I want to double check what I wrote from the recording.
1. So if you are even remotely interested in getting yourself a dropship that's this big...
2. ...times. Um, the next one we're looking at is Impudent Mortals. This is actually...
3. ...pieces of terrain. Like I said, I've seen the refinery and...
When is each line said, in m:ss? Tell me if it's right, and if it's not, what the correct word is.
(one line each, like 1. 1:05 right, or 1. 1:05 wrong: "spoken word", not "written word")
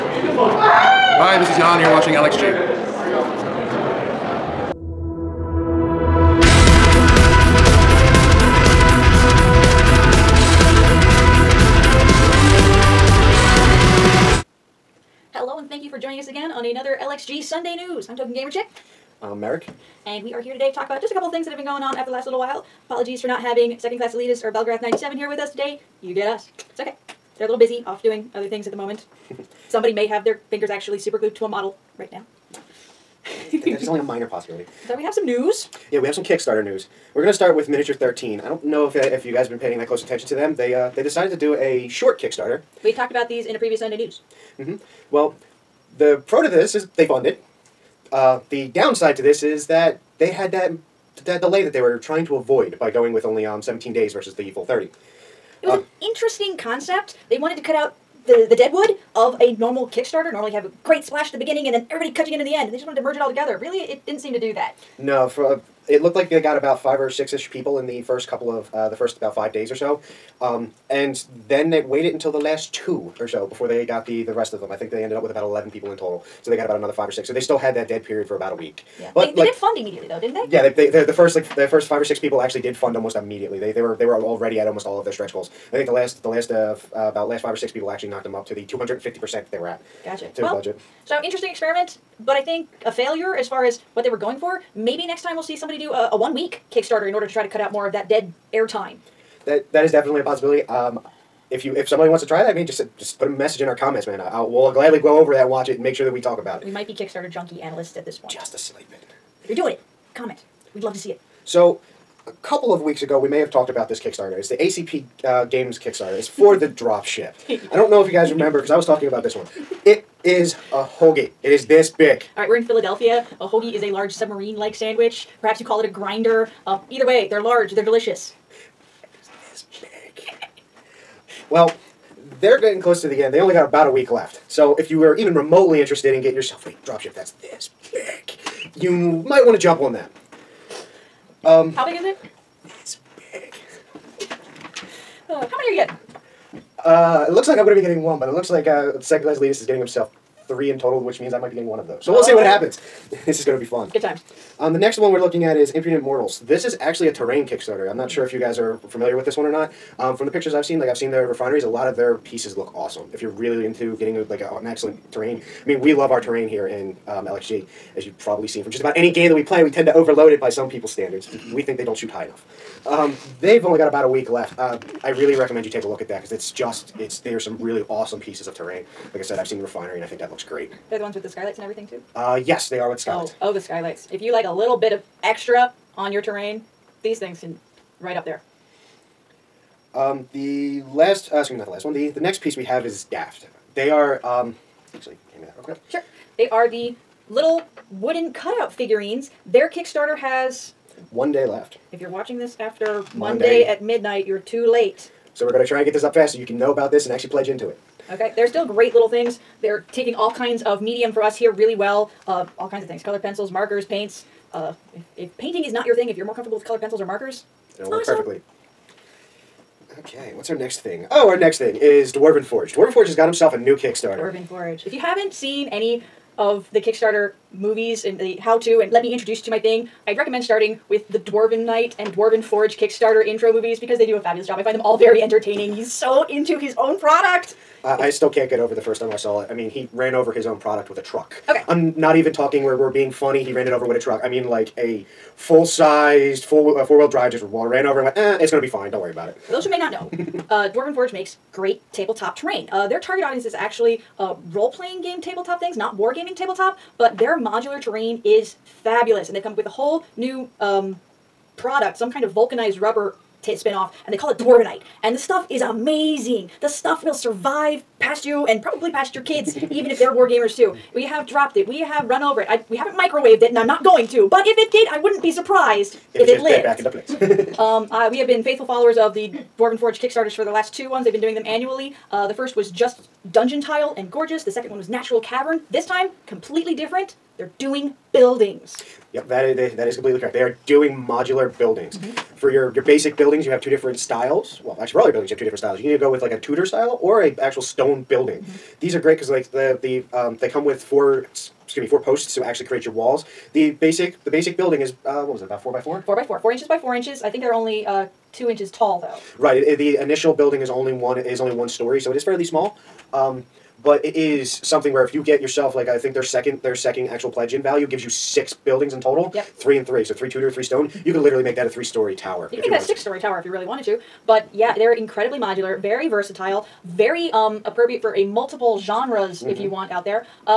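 1. 2:14 right
2. 2:34 right
3. 2:58 right.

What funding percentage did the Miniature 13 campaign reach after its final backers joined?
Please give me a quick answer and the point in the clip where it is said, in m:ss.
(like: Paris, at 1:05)
250%, at 1:28.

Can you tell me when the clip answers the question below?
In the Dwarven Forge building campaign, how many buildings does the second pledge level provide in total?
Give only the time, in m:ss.
5:18.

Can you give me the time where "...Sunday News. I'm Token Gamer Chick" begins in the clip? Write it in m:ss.
0:17.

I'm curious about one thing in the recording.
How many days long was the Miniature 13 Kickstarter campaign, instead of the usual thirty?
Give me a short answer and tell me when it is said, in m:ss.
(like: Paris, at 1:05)
17, at 0:53.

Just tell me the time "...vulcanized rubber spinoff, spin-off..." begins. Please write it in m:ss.
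4:22.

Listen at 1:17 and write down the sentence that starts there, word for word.
So they still had that dead period for about a week.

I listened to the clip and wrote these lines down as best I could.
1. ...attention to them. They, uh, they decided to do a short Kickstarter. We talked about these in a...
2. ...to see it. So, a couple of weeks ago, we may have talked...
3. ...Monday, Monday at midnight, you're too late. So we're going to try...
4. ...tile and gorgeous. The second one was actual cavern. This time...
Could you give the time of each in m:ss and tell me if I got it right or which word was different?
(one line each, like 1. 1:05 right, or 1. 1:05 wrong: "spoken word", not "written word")
1. 0:40 right
2. 1:50 right
3. 3:23 right
4. 4:43 wrong: "natural", not "actual".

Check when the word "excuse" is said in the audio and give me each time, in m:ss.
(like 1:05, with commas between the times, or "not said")
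3:11, 5:01.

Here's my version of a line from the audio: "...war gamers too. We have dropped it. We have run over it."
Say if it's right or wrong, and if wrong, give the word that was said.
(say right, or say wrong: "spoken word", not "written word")
right.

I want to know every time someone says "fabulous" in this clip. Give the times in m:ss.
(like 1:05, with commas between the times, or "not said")
3:54, 4:18.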